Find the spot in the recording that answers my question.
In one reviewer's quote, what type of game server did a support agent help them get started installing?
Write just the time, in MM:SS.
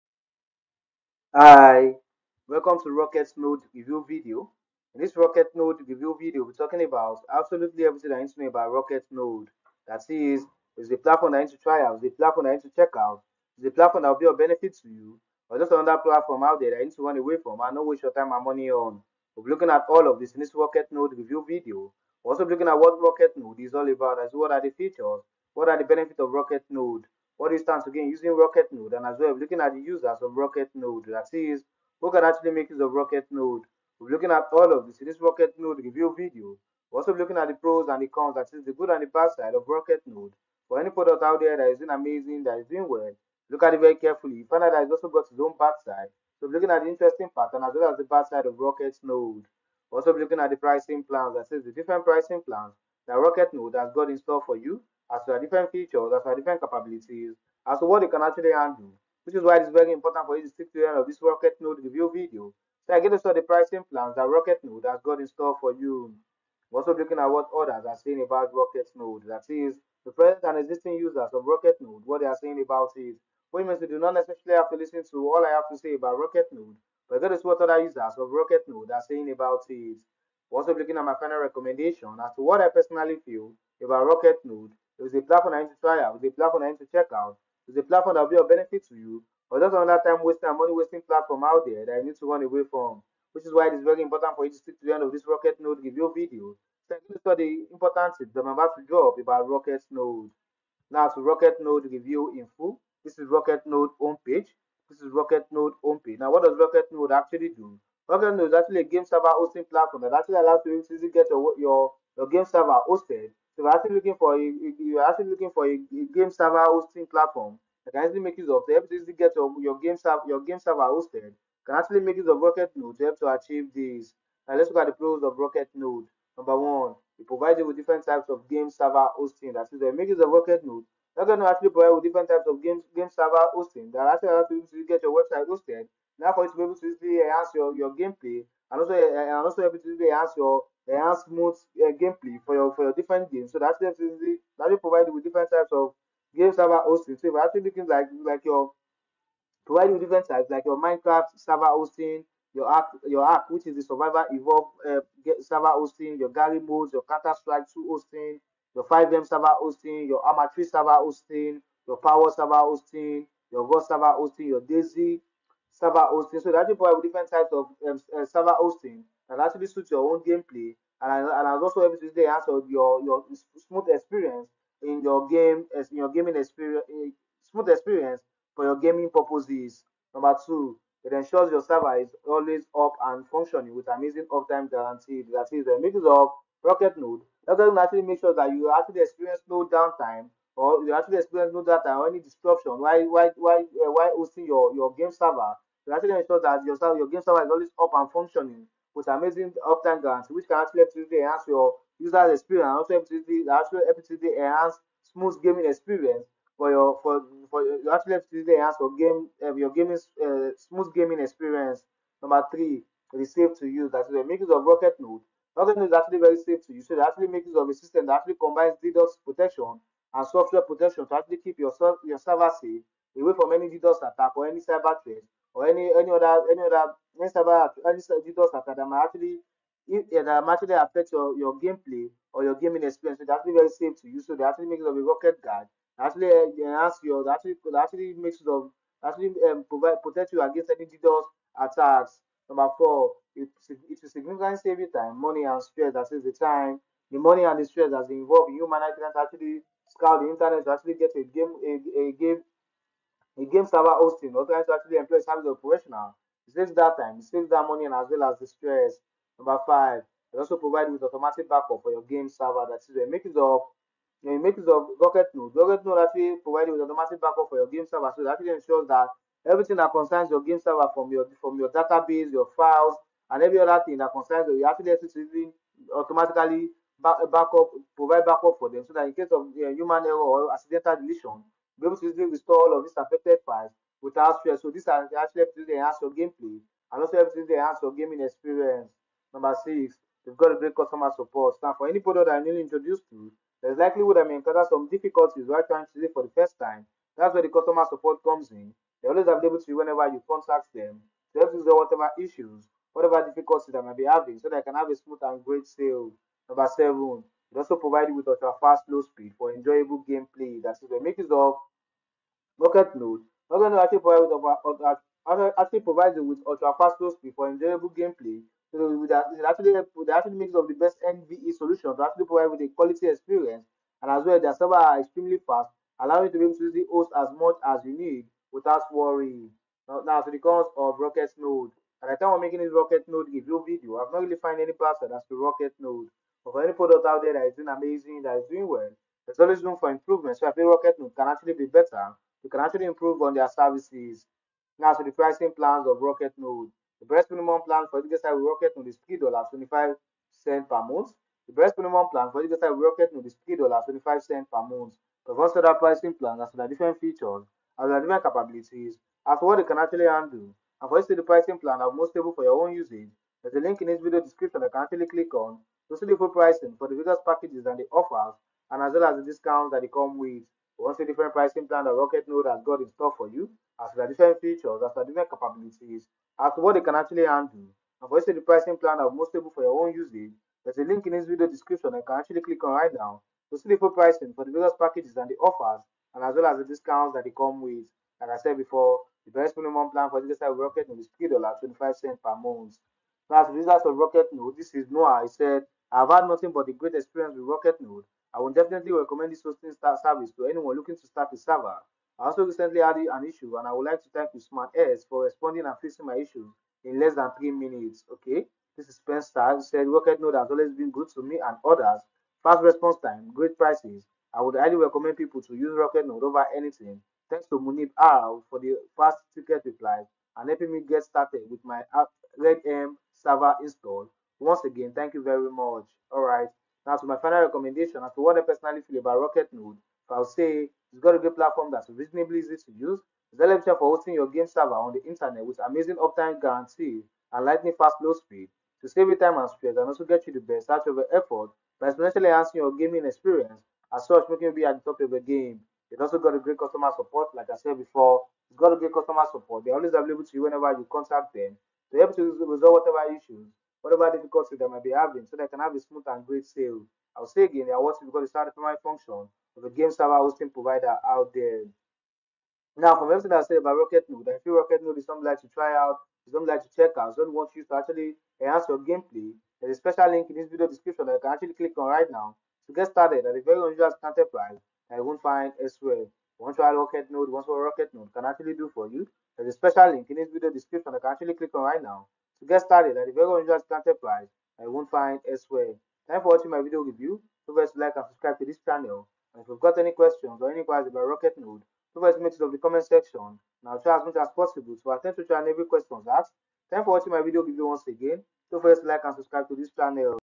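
07:02.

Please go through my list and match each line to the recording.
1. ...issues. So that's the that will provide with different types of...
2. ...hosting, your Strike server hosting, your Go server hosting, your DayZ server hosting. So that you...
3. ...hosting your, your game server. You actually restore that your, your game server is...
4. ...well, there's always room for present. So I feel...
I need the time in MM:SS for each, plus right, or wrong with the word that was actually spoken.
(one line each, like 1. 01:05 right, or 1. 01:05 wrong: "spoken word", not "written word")
1. 02:23 wrong: "games", not "issues"
2. 02:40 wrong: "Power", not "Strike"
3. 03:14 wrong: "ensure", not "restore"
4. 05:38 wrong: "improvement", not "present".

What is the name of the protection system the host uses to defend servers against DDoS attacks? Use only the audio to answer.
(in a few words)
Rocket Guard.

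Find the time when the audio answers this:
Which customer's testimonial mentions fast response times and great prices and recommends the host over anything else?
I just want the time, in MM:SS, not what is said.
06:48.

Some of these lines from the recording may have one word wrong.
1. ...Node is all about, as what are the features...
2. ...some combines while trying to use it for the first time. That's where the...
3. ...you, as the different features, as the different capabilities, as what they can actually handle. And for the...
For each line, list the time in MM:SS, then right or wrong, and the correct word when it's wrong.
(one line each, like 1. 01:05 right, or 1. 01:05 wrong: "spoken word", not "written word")
1. 00:23 right
2. 04:54 wrong: "difficulties", not "combines"
3. 06:13 right.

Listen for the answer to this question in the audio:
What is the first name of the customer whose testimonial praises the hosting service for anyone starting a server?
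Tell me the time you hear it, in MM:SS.
06:34.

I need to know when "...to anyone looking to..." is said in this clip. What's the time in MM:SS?
06:40.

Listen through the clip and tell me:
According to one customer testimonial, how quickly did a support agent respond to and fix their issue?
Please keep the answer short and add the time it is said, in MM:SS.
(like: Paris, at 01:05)
less than 3 minutes, at 06:46.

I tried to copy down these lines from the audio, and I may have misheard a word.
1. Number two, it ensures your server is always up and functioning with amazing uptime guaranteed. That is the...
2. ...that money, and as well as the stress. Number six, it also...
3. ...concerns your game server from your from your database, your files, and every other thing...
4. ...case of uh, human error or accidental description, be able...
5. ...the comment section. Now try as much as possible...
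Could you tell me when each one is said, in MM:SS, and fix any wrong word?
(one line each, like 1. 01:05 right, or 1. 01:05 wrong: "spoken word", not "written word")
1. 03:00 right
2. 04:17 wrong: "five", not "six"
3. 04:29 right
4. 04:39 wrong: "deletion", not "description"
5. 08:12 right.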